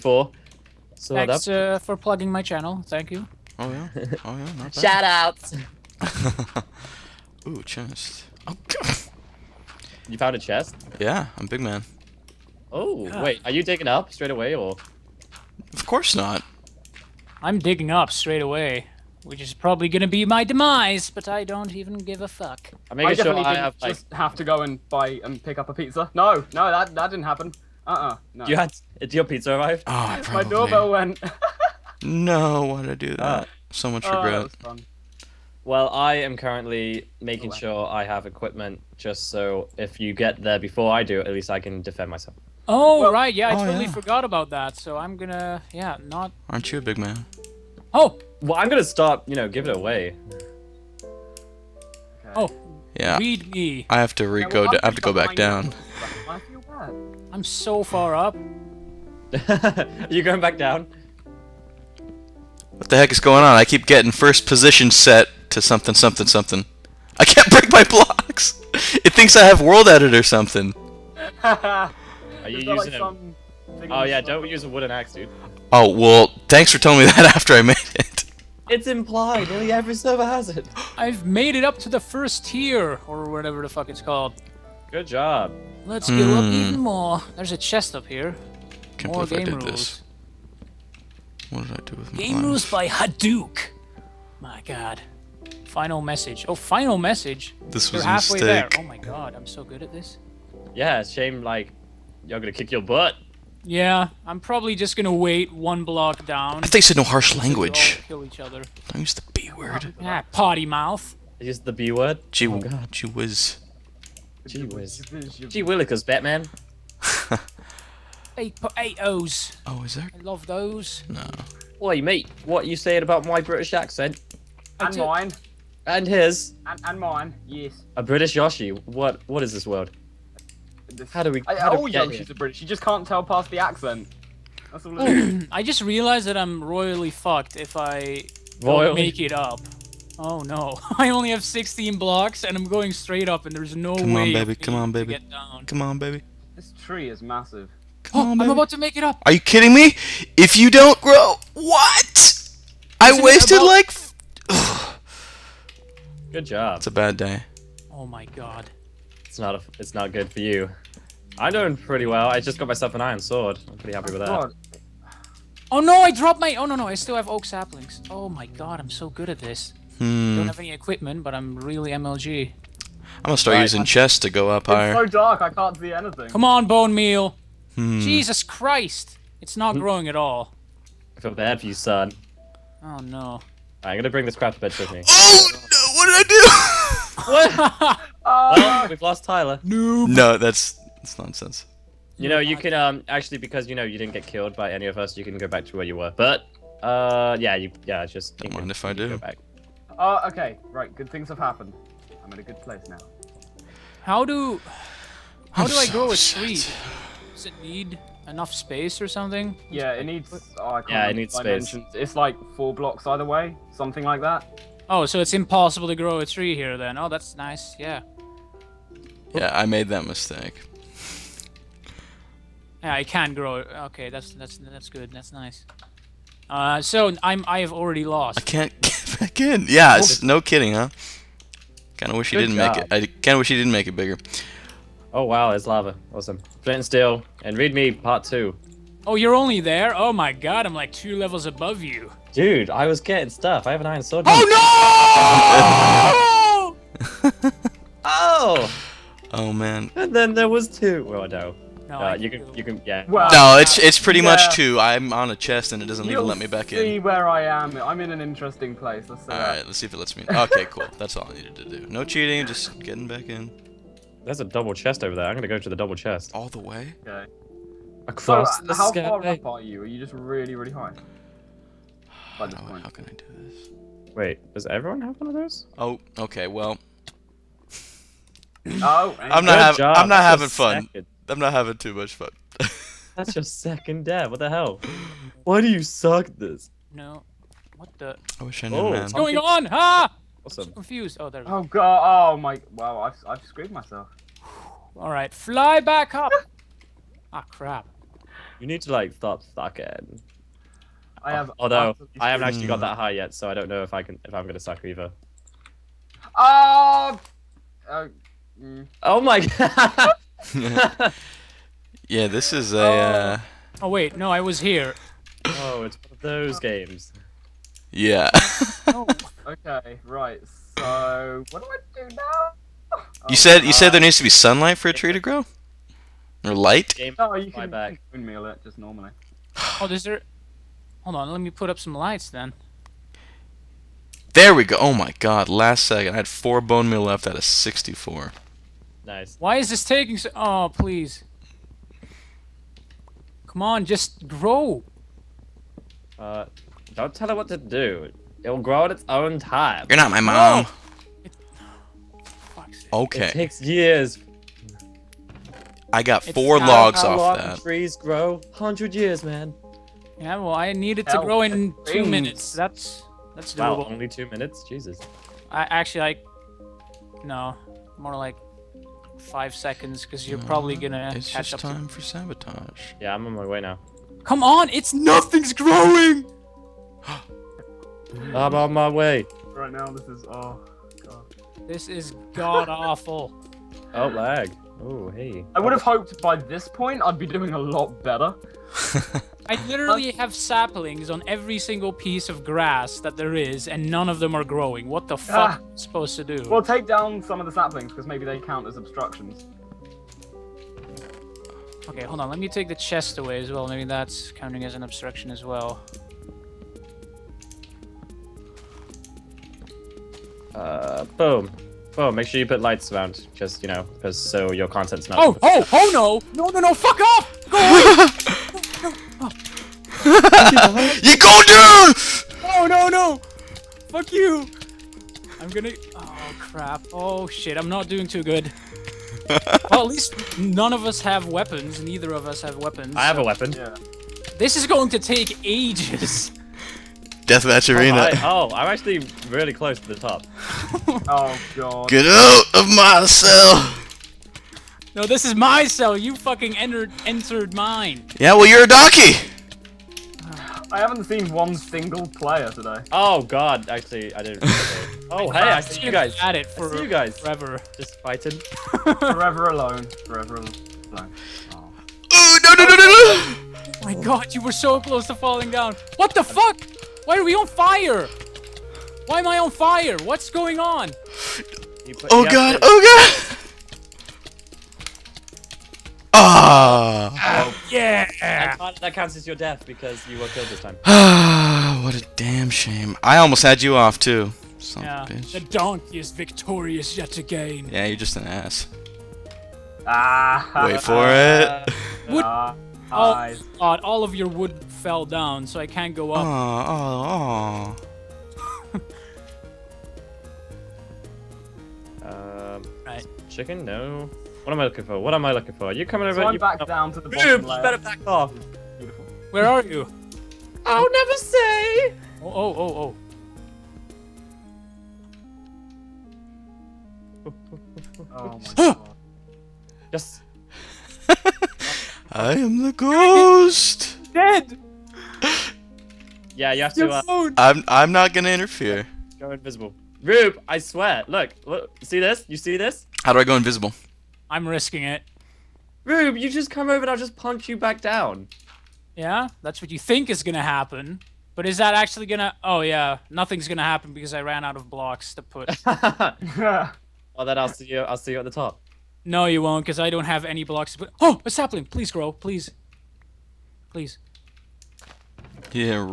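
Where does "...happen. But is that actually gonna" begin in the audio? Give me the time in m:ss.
9:00.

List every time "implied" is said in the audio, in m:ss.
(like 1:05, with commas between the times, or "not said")
1:18.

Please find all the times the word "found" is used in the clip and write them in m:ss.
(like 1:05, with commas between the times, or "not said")
0:10.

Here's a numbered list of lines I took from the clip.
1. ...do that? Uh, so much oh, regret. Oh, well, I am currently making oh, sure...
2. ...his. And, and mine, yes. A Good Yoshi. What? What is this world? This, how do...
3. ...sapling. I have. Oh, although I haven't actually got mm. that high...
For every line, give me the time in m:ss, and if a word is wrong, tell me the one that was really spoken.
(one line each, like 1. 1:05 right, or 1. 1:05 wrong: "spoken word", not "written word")
1. 0:32 right
2. 2:06 wrong: "British", not "Good"
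3. 4:59 wrong: "sucking", not "sapling".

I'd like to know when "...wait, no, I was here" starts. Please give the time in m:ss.
5:13.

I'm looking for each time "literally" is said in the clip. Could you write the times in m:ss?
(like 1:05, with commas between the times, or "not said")
6:29.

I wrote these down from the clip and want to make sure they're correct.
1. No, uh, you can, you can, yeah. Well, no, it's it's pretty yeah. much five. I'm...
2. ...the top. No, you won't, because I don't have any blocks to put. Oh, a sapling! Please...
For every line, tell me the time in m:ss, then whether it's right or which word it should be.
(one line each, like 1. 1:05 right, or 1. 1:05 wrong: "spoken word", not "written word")
1. 4:11 wrong: "two", not "five"
2. 9:08 right.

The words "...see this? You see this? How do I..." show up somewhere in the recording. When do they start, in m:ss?
8:51.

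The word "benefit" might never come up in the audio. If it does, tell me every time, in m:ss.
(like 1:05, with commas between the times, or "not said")
not said.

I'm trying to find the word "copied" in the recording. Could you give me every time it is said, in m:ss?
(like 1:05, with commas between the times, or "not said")
not said.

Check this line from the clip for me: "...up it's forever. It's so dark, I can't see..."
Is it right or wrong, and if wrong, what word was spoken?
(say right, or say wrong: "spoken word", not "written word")
wrong: "higher", not "forever".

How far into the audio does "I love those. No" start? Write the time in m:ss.
2:00.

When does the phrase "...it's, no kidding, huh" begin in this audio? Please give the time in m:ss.
3:49.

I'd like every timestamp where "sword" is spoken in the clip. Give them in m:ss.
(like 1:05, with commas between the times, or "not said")
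2:43, 4:04.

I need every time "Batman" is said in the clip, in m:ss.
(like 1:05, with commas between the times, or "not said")
1:56.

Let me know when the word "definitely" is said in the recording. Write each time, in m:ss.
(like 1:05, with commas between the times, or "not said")
0:23.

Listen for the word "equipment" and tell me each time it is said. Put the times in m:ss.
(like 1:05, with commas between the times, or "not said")
0:38, 2:50.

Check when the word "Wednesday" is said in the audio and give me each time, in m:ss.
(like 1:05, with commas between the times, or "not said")
not said.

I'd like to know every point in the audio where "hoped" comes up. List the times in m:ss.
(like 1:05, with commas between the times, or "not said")
6:25.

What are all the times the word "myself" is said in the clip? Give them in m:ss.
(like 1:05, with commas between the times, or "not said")
0:42, 2:42, 4:53.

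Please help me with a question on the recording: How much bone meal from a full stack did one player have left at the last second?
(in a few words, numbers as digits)
4.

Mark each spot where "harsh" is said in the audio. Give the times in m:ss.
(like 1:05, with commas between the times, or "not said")
1:47.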